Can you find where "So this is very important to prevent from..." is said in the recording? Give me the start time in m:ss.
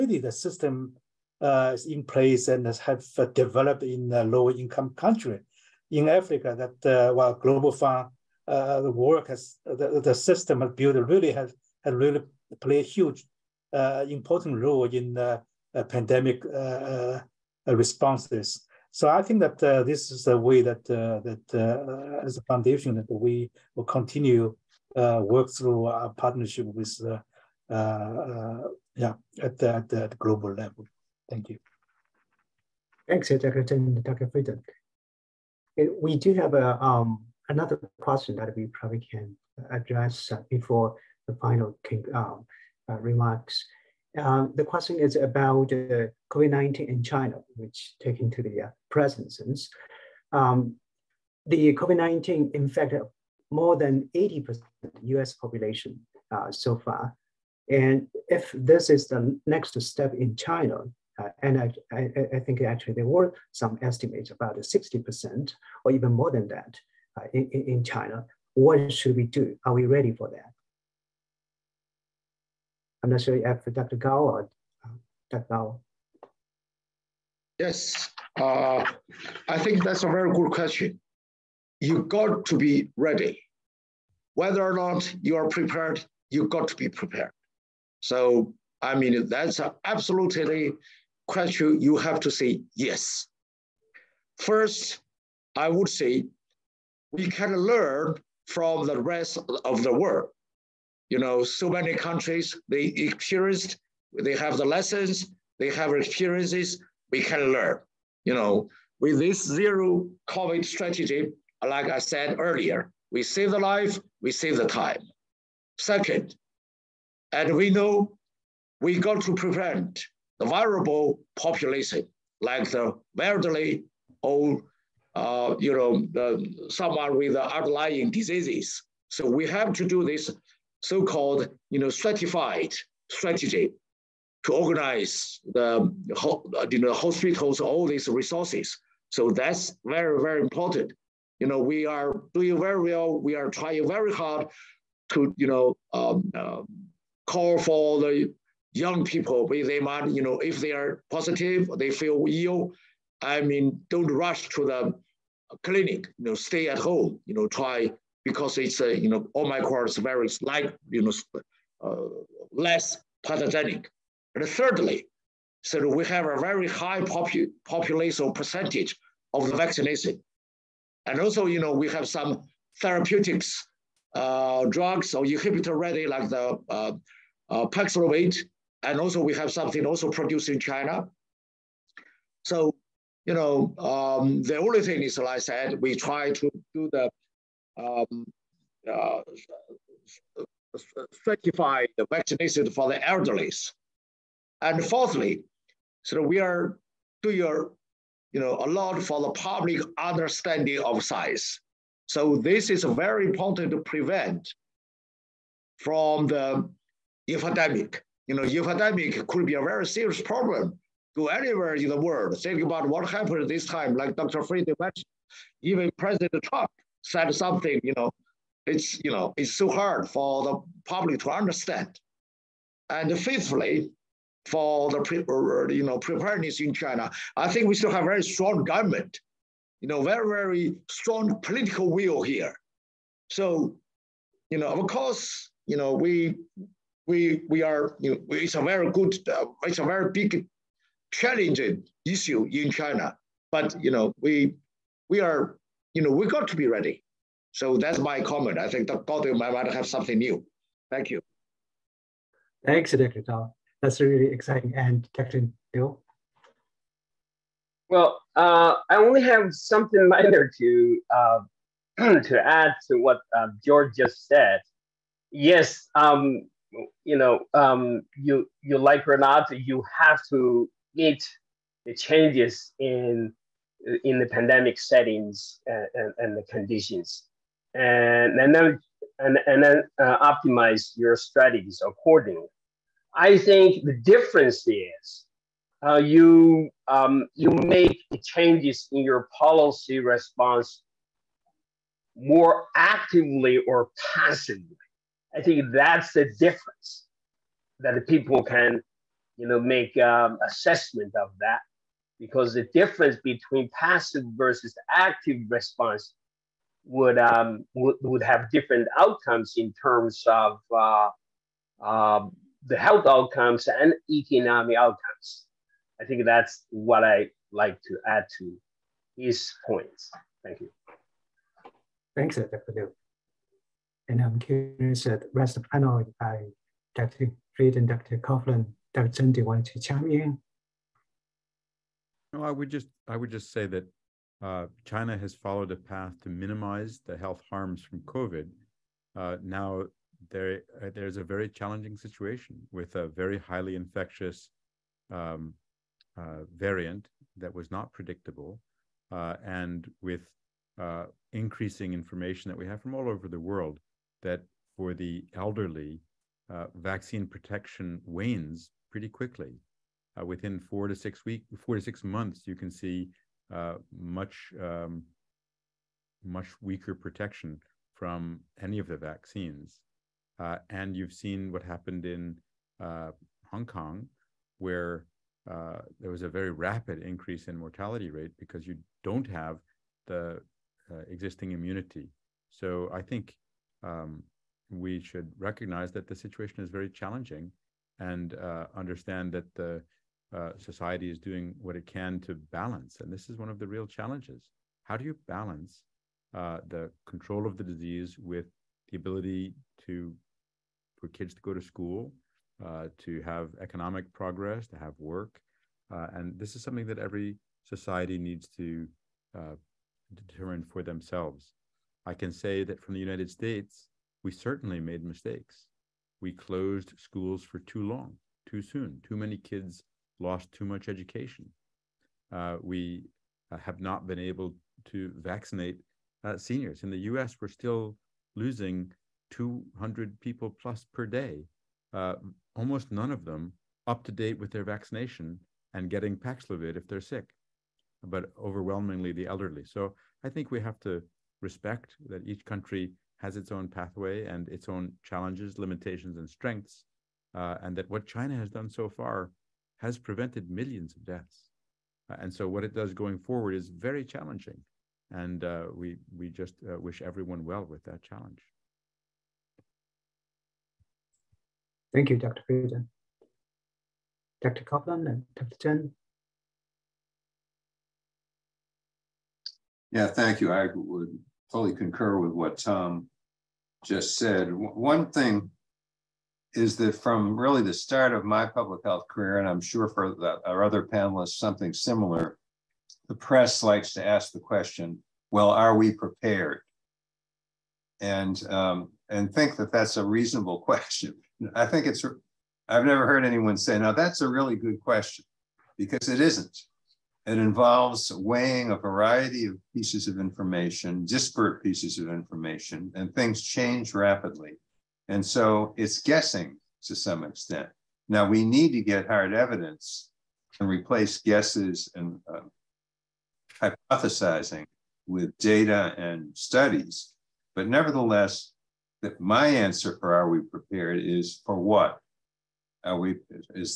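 3:22.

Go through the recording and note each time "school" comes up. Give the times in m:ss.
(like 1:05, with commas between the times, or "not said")
6:41, 6:56.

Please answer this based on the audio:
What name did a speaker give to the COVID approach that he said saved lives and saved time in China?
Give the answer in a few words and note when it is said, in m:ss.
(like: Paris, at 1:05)
zero COVID strategy, at 1:49.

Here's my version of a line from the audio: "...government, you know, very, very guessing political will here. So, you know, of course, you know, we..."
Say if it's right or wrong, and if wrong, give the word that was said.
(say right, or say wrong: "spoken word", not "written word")
wrong: "strong", not "guessing".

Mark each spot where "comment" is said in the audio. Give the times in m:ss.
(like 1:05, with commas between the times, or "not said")
4:08.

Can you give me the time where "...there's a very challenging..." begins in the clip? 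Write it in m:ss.
5:40.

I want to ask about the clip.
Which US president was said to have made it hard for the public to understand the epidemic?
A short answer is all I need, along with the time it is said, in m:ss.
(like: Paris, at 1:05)
President Trump, at 3:35.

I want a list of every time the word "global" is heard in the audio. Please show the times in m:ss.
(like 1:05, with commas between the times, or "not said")
0:07, 0:30.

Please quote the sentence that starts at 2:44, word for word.
And thirdly, so we have a very high popu- population percentage of the vaccination.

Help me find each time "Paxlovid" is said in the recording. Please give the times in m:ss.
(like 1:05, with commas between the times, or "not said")
2:57, 7:16.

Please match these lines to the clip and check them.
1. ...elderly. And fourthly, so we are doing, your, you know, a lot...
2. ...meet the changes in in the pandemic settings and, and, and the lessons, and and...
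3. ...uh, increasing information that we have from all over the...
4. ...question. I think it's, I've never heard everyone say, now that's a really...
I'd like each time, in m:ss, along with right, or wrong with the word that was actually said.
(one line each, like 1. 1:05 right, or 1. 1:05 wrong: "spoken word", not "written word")
1. 3:13 right
2. 4:30 wrong: "conditions", not "lessons"
3. 5:50 right
4. 8:10 wrong: "anyone", not "everyone".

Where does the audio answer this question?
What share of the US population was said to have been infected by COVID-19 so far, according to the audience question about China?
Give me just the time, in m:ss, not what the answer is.
0:53.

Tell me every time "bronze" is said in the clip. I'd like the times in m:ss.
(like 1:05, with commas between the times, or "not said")
not said.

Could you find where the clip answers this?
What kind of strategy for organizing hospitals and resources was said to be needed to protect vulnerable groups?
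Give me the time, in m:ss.
2:11.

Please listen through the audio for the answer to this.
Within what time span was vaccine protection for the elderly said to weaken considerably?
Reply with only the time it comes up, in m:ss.
6:01.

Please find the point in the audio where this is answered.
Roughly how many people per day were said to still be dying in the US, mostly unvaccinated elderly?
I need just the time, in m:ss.
7:09.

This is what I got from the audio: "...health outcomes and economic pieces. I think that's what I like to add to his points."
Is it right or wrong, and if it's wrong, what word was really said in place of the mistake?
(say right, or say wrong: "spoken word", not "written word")
wrong: "outcomes", not "pieces".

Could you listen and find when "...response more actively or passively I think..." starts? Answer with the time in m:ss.
4:50.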